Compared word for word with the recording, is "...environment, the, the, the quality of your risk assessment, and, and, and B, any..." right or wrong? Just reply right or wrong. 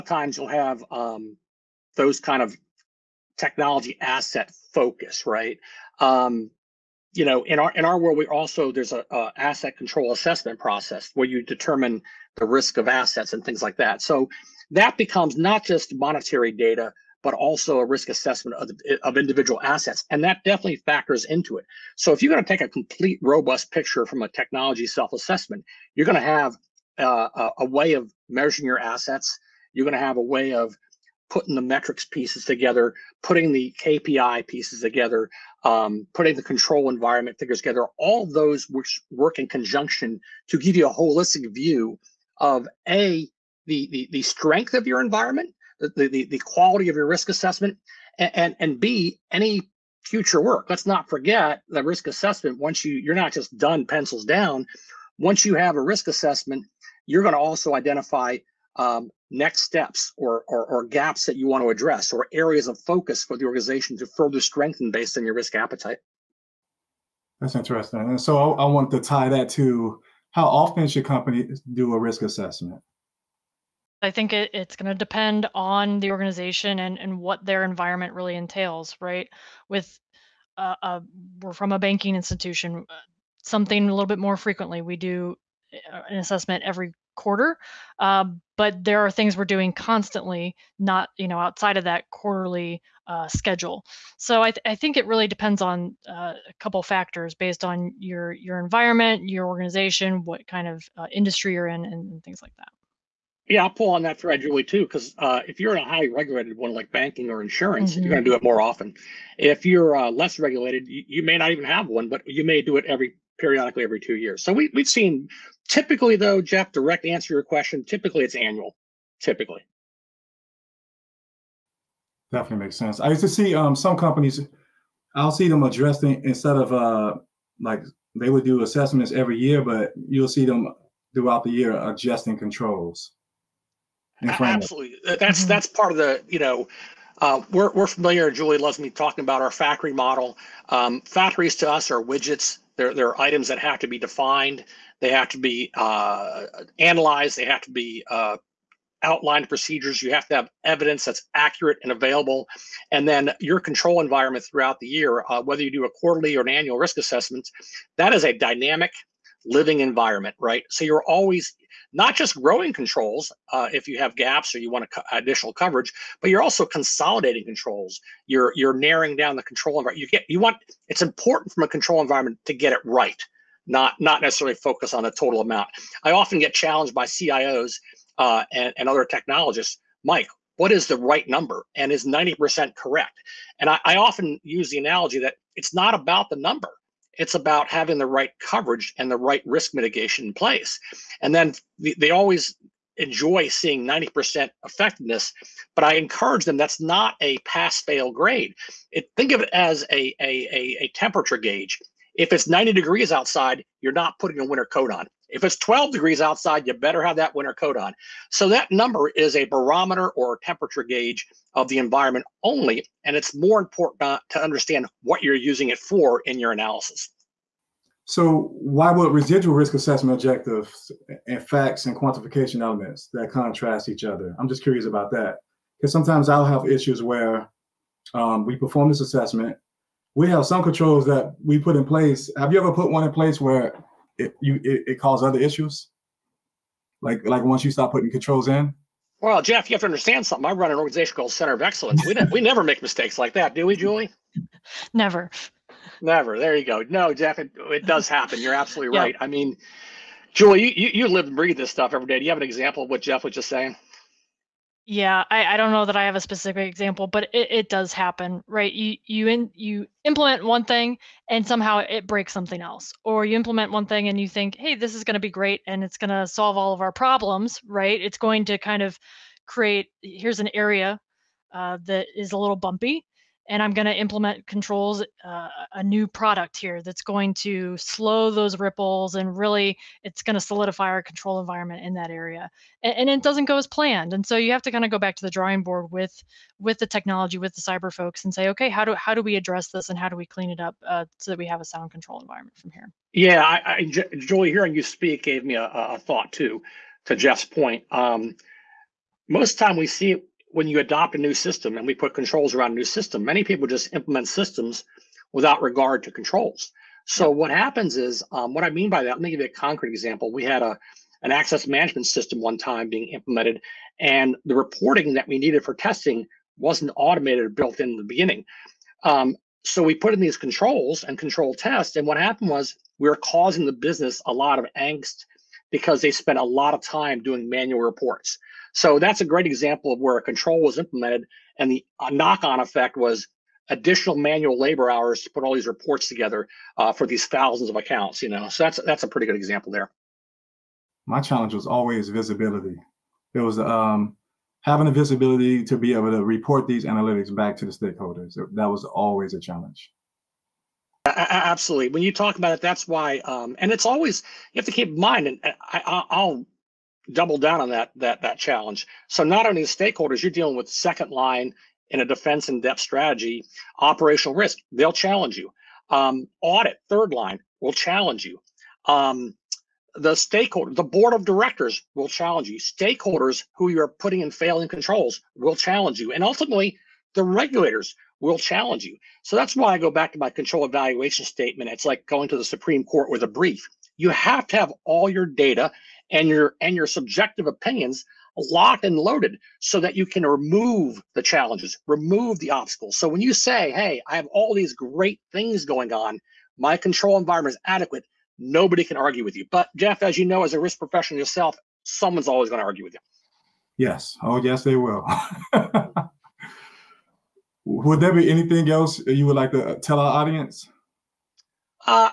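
right.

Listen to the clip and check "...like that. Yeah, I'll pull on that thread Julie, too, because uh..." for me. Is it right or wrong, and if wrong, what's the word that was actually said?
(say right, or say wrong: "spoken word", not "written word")
right.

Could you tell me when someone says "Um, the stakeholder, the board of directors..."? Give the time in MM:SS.
06:08.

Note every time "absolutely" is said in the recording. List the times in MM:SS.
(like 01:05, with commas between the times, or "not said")
02:14, 04:08, 05:51.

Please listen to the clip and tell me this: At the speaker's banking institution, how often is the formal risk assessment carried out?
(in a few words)
Every quarter.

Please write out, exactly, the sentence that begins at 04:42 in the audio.
And, and it doesn't go as planned.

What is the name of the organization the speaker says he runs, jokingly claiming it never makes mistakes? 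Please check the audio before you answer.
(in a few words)
Center of Excellence.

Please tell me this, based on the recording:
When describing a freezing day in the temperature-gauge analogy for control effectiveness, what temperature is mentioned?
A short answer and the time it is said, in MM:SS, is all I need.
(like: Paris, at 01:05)
12 degrees, at 03:25.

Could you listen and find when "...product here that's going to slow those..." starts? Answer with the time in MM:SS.
04:36.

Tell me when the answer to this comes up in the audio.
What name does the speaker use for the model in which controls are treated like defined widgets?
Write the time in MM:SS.
02:19.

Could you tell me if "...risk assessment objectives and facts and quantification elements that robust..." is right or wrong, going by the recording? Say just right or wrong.
wrong.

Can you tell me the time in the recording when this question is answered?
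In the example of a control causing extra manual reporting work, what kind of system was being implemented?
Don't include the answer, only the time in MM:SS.
05:11.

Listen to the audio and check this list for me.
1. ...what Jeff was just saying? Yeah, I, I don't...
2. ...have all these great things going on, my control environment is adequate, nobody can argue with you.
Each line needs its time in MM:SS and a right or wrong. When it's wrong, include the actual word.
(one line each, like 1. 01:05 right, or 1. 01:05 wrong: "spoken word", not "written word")
1. 04:12 right
2. 06:34 right.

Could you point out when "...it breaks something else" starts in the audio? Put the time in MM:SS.
04:21.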